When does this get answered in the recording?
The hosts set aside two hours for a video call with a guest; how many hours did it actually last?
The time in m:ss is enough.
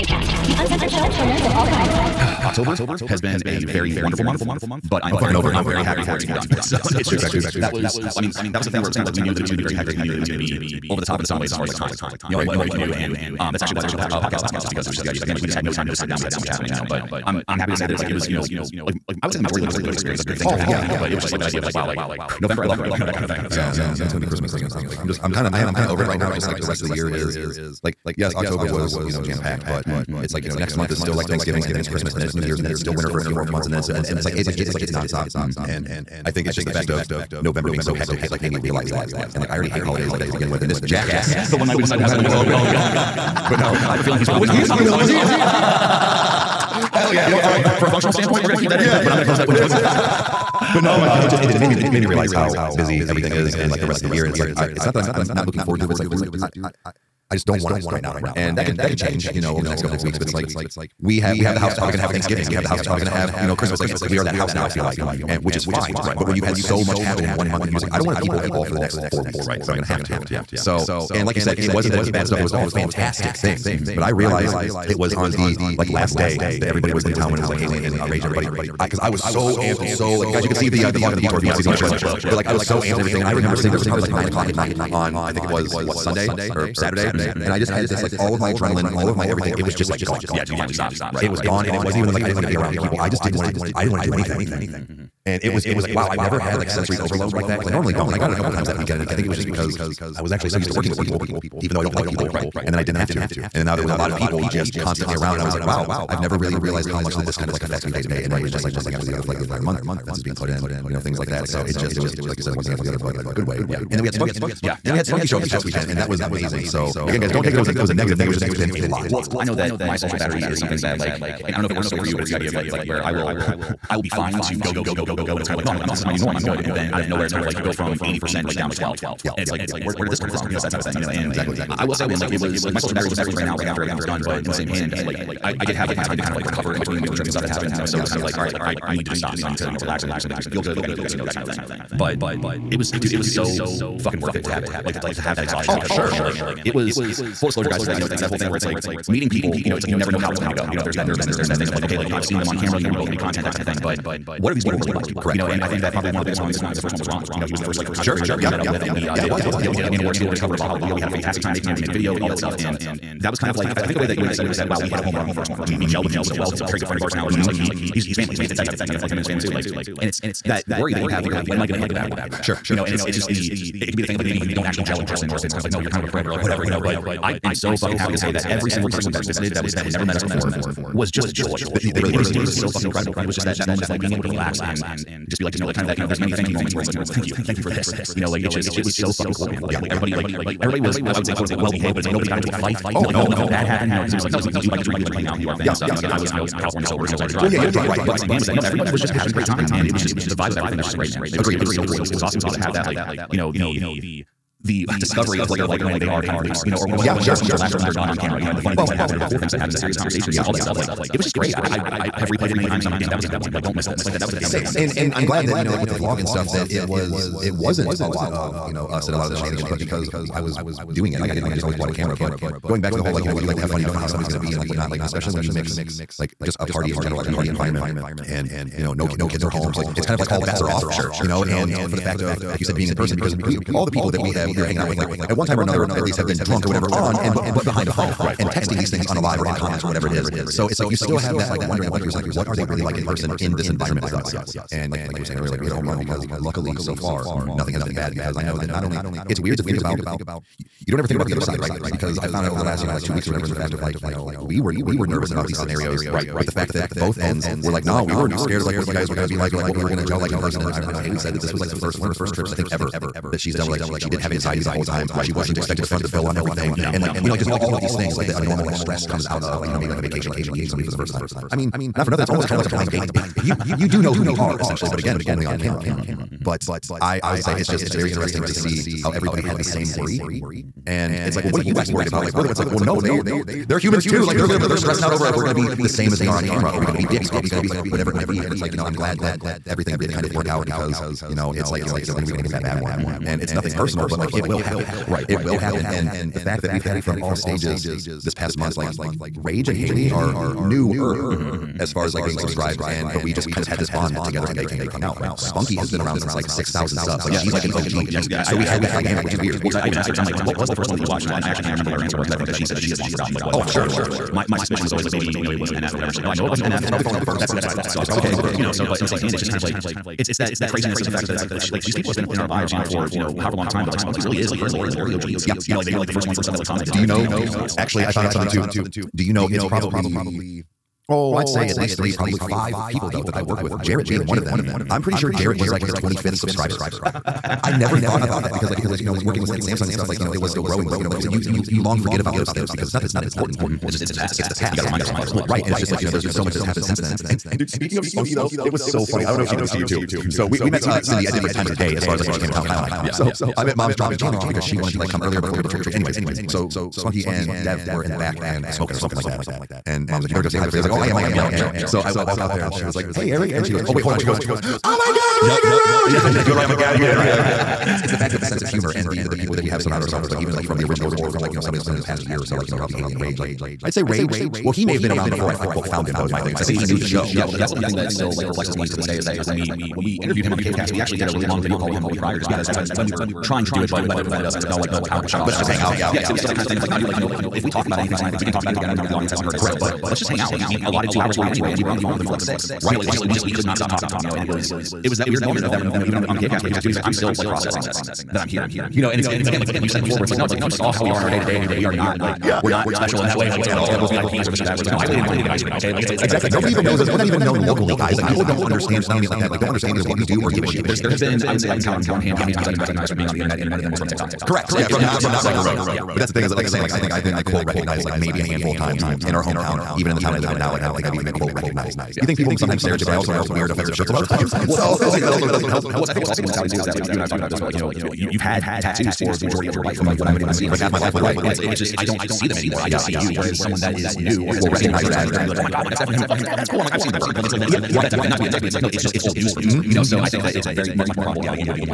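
6:32.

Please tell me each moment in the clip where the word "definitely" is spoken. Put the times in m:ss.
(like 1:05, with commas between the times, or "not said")
2:13, 7:15.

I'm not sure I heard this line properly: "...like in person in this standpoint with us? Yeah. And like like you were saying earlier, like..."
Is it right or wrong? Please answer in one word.
wrong.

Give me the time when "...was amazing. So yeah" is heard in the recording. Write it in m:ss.
1:56.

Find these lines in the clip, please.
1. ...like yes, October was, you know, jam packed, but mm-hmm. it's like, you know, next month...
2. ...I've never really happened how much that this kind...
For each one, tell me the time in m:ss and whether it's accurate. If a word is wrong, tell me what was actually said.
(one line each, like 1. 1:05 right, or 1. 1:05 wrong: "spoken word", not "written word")
1. 0:27 right
2. 1:46 wrong: "realized", not "happened".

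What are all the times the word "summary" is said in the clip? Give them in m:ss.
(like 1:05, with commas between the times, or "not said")
not said.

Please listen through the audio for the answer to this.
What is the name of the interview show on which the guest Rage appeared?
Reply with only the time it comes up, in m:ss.
6:20.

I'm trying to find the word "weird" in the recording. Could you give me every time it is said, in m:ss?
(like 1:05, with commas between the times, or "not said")
4:09, 5:09, 6:35, 7:03.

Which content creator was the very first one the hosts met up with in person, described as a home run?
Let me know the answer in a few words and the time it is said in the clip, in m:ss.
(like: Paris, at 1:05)
Ron, at 2:37.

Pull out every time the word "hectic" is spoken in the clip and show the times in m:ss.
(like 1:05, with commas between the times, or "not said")
0:09, 0:37.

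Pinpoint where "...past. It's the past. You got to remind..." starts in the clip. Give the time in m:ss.
5:44.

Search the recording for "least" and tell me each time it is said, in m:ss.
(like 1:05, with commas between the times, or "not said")
3:56, 5:31.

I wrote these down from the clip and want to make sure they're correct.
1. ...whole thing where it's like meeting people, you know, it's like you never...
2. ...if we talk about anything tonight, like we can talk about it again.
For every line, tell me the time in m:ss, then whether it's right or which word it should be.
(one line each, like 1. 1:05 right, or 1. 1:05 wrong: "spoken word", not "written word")
1. 2:28 right
2. 6:27 right.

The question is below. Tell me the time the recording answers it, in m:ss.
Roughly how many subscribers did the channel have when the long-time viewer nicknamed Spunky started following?
5:06.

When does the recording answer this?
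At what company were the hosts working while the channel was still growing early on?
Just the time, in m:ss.
5:39.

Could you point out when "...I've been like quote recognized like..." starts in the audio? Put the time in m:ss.
6:57.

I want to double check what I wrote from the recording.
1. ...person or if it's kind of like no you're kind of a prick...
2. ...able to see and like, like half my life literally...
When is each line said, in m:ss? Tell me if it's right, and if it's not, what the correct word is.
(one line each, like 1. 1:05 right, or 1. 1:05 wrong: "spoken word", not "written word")
1. 2:55 right
2. 7:10 right.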